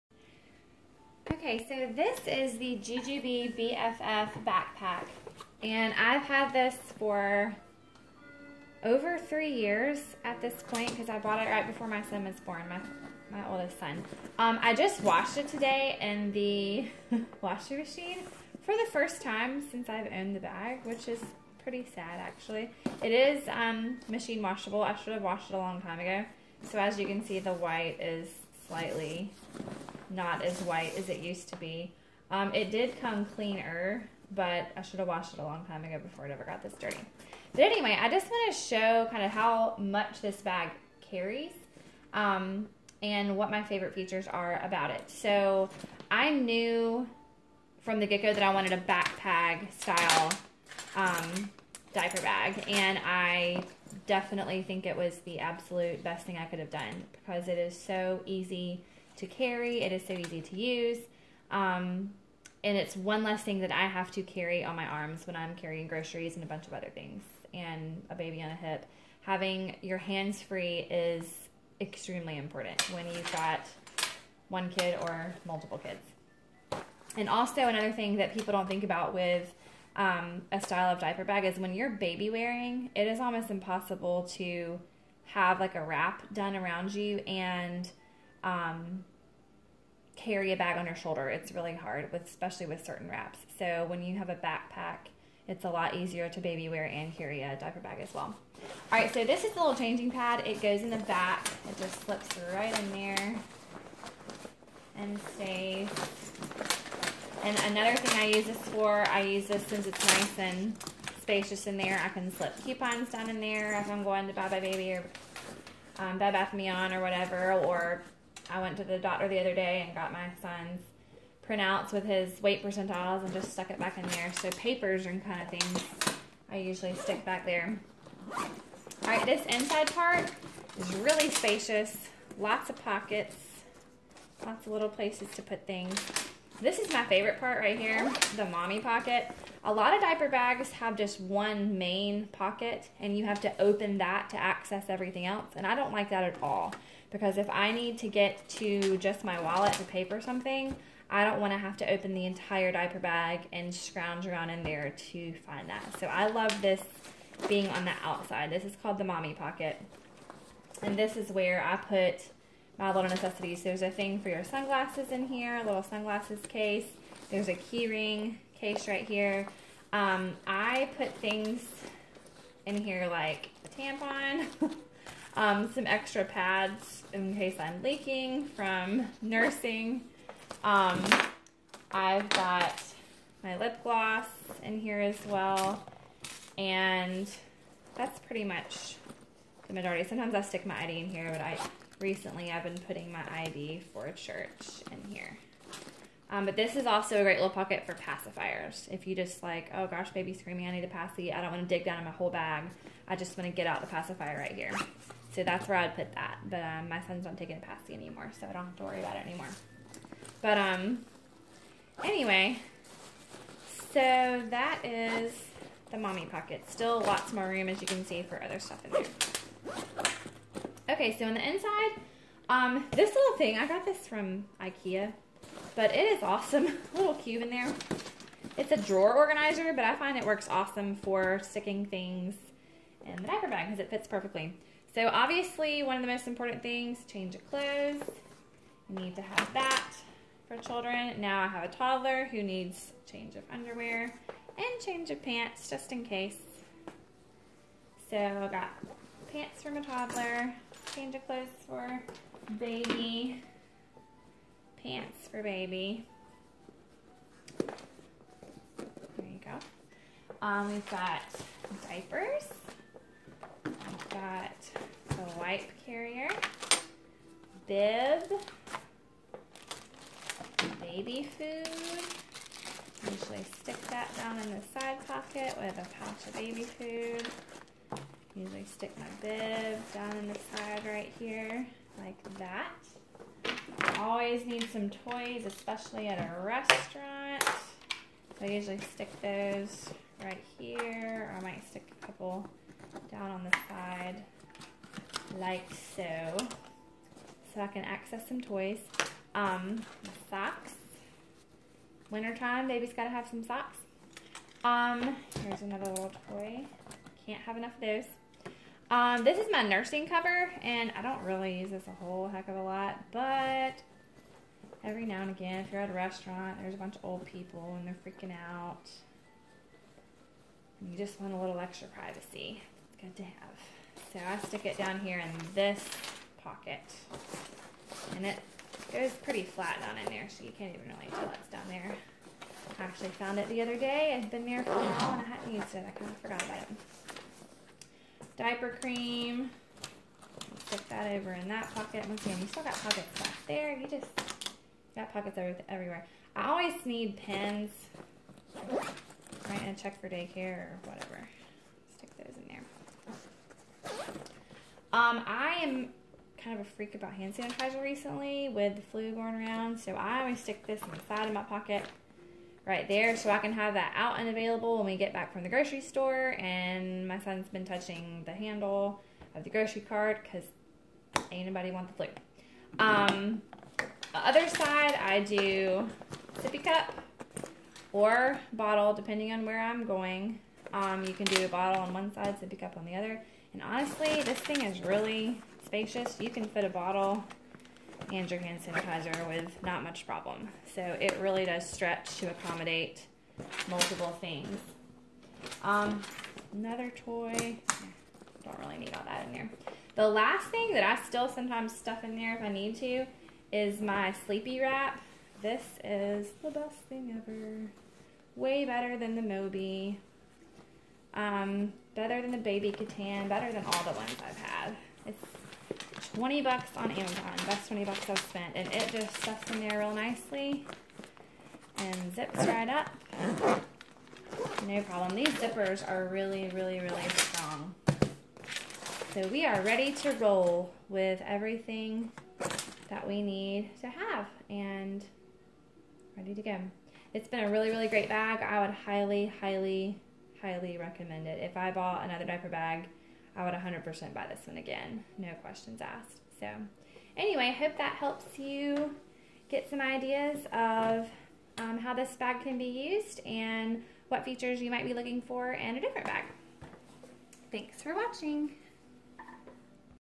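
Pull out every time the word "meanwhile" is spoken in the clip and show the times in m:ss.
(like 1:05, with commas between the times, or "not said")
not said.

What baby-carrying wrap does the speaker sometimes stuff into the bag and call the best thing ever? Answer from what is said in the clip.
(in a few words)
Sleepy Wrap.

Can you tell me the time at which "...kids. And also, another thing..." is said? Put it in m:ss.
1:15.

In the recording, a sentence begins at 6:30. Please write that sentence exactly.
So it really does stretch to accommodate multiple things.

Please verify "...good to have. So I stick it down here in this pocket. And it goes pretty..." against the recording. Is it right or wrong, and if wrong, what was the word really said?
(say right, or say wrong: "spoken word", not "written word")
right.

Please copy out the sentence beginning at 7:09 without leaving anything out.
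So we are ready to roll with everything that we need to have and ready to go.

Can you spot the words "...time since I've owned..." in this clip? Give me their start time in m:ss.
0:19.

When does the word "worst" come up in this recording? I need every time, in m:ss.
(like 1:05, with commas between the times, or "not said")
not said.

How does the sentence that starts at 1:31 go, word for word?
It's really hard, with, especially with certain wraps.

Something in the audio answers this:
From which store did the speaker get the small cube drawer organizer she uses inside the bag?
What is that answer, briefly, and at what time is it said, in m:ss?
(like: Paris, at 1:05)
Ikea, at 3:44.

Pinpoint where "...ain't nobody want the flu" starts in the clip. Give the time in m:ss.
6:11.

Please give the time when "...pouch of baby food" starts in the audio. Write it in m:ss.
4:35.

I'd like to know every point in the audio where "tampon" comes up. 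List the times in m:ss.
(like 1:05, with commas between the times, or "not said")
2:53.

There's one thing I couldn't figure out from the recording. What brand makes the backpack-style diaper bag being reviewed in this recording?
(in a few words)
JuJuBe.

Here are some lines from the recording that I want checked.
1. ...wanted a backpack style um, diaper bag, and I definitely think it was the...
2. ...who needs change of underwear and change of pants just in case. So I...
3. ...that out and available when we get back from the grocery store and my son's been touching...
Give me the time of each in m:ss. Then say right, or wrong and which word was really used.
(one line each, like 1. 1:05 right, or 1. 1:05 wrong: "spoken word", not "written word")
1. 0:48 right
2. 4:02 right
3. 6:03 right.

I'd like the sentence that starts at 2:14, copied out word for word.
Lots of little places to put things.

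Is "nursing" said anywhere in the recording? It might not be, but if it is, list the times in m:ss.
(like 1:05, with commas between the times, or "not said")
2:59, 5:09.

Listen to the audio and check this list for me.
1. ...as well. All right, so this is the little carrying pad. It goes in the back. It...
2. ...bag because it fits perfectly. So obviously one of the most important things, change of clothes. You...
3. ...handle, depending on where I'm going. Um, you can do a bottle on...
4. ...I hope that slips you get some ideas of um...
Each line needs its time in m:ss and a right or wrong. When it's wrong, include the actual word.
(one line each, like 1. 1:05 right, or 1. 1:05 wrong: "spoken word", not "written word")
1. 1:38 wrong: "changing", not "carrying"
2. 3:53 right
3. 6:18 wrong: "bottle", not "handle"
4. 7:27 wrong: "helps", not "slips".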